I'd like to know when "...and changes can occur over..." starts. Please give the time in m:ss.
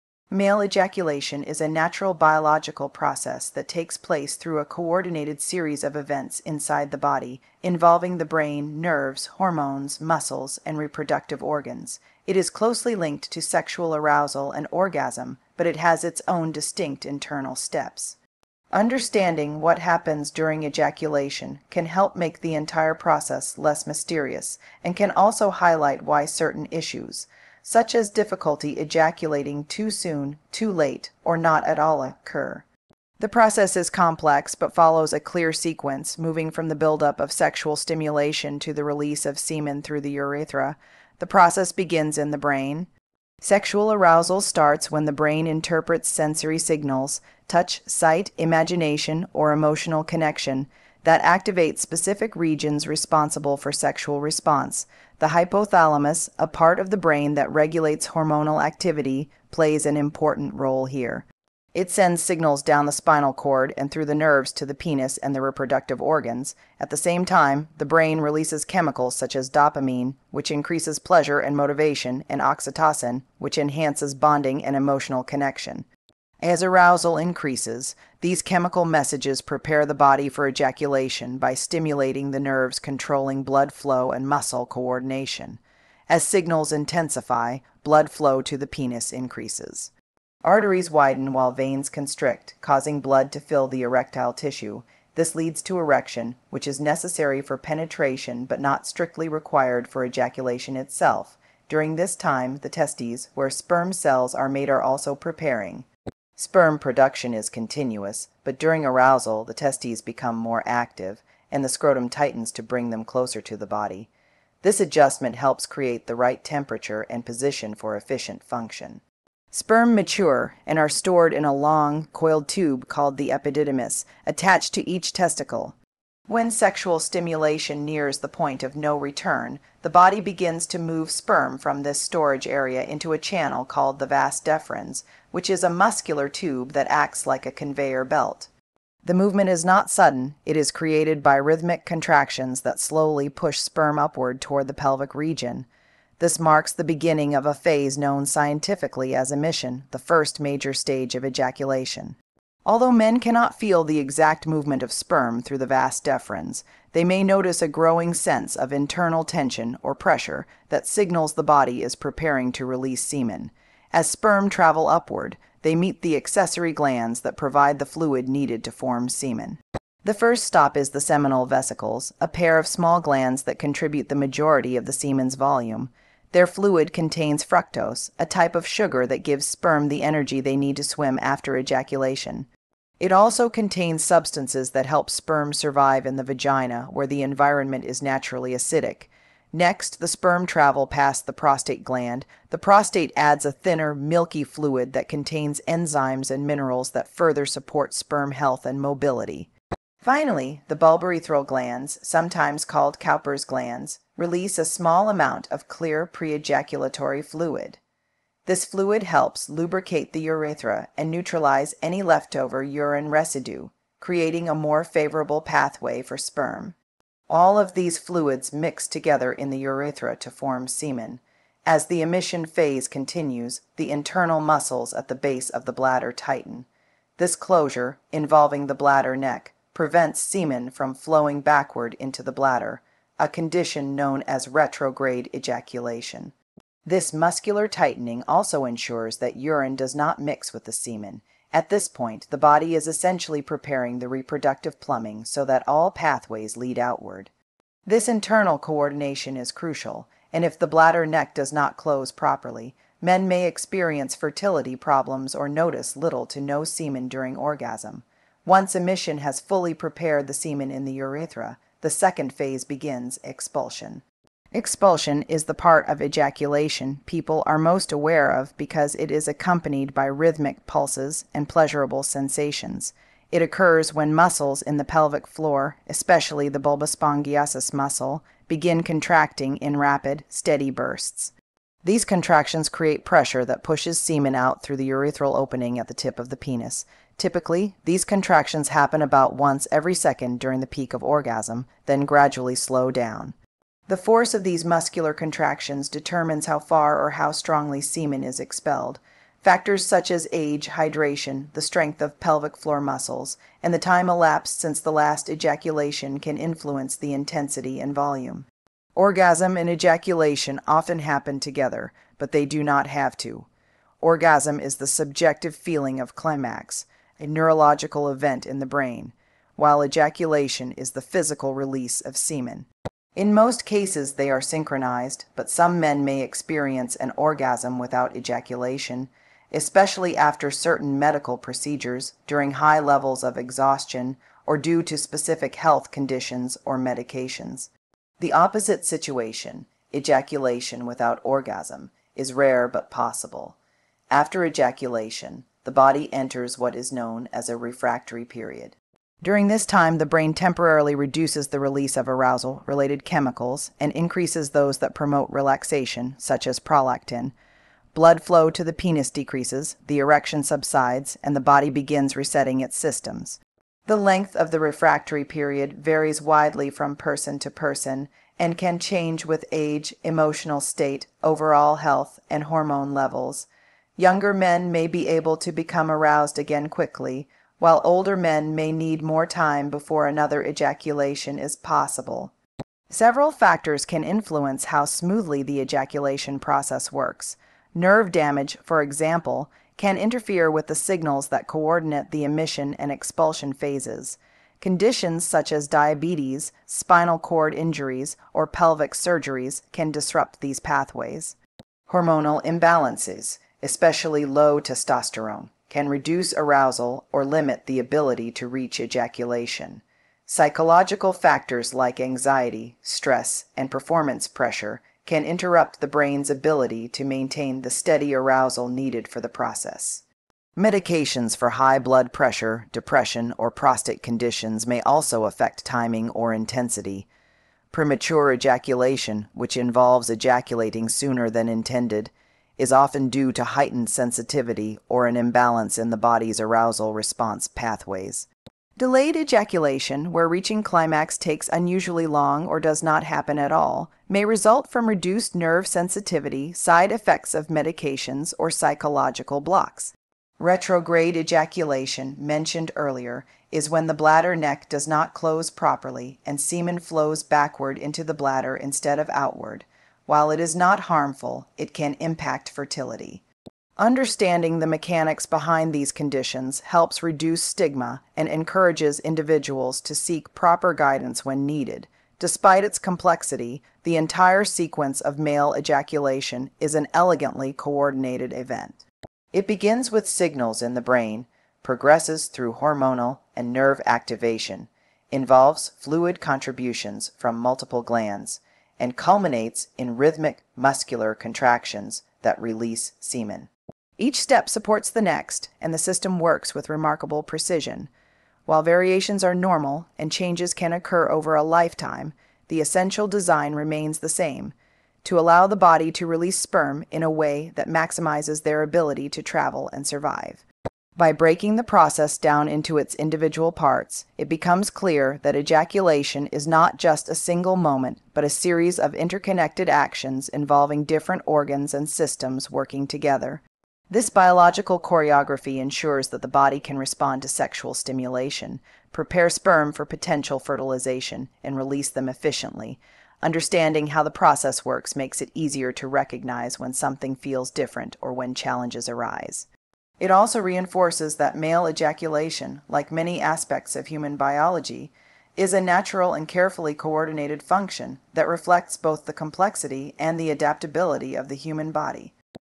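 8:19.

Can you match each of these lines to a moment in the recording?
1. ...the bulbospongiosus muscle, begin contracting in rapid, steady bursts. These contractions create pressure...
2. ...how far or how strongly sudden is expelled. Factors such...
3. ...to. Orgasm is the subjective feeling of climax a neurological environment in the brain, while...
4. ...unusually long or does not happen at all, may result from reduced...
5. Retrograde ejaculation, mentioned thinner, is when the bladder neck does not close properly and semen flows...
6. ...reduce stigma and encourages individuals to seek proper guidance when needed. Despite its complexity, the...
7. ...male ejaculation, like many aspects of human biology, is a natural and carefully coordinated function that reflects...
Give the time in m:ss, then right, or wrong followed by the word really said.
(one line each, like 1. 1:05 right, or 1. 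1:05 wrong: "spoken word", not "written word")
1. 4:36 right
2. 4:56 wrong: "semen", not "sudden"
3. 5:13 wrong: "event", not "environment"
4. 7:21 right
5. 7:30 wrong: "earlier", not "thinner"
6. 7:47 right
7. 9:01 right.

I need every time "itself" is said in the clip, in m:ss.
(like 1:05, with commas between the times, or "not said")
1:40.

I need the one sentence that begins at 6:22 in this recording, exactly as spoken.
Several factors can influence how smoothly the ejaculation process works.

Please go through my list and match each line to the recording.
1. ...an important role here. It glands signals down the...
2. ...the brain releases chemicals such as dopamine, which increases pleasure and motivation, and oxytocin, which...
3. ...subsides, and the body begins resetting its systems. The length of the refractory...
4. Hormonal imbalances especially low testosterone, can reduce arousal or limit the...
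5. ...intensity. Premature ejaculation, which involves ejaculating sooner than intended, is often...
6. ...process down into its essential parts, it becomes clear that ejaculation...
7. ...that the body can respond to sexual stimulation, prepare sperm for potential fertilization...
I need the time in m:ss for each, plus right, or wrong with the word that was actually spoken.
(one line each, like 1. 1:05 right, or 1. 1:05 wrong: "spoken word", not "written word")
1. 0:59 wrong: "sends", not "glands"
2. 1:07 right
3. 6:00 right
4. 6:41 right
5. 7:06 right
6. 8:31 wrong: "individual", not "essential"
7. 8:46 right.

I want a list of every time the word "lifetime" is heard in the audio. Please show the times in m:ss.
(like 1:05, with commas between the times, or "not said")
8:21.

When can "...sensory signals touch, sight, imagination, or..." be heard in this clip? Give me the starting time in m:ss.
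0:46.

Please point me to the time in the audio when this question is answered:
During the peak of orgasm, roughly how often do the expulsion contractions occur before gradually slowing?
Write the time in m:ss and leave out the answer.
4:49.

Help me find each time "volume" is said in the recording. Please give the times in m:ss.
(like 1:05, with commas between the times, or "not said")
2:55, 5:07.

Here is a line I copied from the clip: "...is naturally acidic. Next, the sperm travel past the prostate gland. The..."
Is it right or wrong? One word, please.
right.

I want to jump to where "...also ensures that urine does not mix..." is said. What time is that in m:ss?
3:58.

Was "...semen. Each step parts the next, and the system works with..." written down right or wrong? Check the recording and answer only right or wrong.
wrong.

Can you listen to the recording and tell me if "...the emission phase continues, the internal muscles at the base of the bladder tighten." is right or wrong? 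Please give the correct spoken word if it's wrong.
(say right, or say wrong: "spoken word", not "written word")
right.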